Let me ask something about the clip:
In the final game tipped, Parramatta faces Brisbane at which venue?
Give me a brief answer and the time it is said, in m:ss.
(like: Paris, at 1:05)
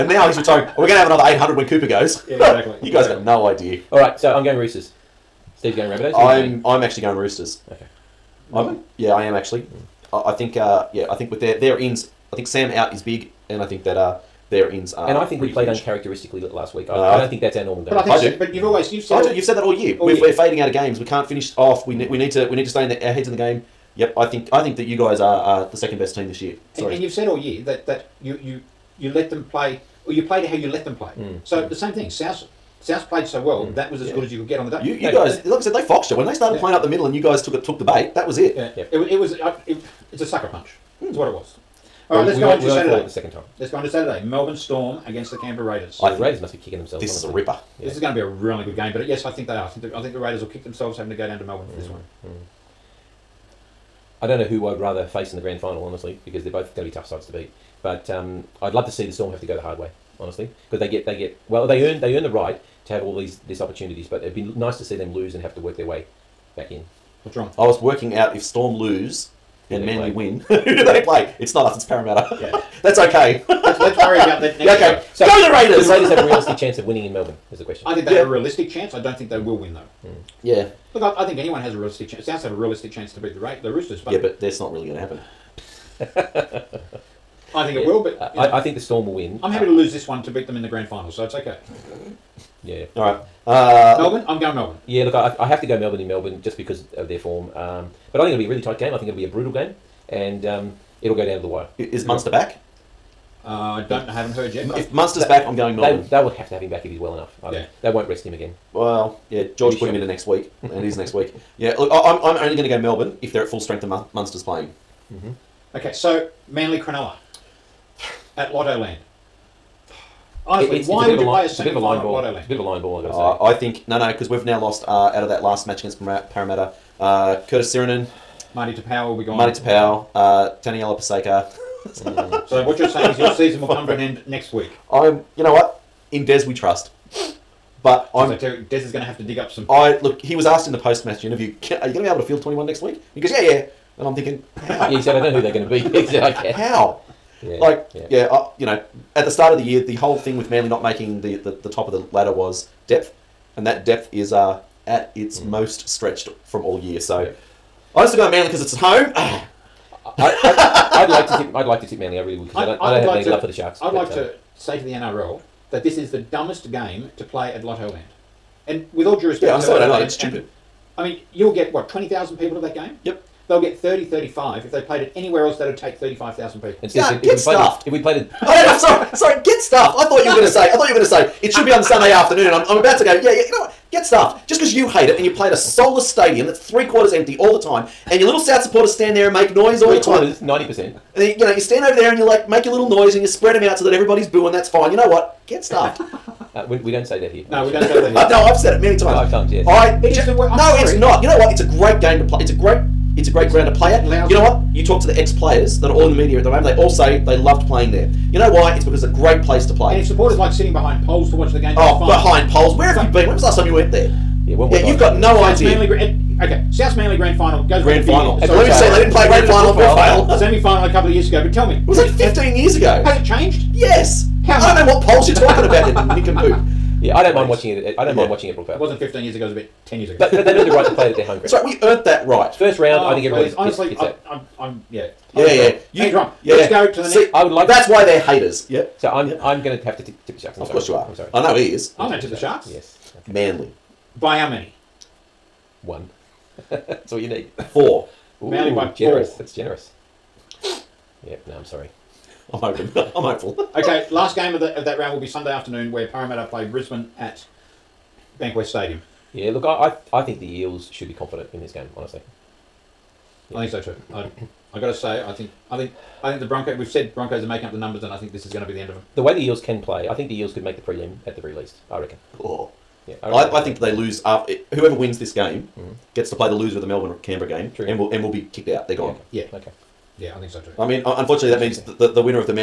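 Bankwest Stadium, at 4:18.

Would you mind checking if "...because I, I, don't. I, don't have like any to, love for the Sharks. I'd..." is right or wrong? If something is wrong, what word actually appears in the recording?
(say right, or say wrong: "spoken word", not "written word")
right.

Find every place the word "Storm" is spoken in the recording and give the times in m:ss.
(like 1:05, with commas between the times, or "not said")
0:44, 0:59, 1:08, 1:28.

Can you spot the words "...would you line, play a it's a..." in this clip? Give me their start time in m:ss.
2:01.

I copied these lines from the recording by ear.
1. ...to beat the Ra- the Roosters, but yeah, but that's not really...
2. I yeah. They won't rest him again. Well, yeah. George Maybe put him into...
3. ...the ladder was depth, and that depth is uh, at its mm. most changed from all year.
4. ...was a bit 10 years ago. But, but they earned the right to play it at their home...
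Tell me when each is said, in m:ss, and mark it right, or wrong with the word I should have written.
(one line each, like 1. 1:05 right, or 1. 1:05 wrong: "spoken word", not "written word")
1. 1:23 right
2. 1:47 right
3. 2:31 wrong: "stretched", not "changed"
4. 3:49 right.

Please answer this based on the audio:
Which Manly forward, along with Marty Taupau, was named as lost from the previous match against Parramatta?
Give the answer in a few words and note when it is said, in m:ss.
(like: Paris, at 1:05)
Curtis Sironen, at 2:07.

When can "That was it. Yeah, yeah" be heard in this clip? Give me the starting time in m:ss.
0:38.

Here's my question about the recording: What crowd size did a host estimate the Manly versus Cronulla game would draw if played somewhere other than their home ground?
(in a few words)
35,000.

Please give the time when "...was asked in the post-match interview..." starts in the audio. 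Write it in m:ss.
2:20.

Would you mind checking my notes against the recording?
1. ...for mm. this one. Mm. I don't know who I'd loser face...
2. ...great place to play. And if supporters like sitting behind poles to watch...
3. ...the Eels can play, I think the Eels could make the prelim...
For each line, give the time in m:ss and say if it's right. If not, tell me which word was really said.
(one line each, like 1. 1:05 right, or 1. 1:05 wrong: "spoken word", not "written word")
1. 0:51 wrong: "rather", not "loser"
2. 3:29 right
3. 4:29 right.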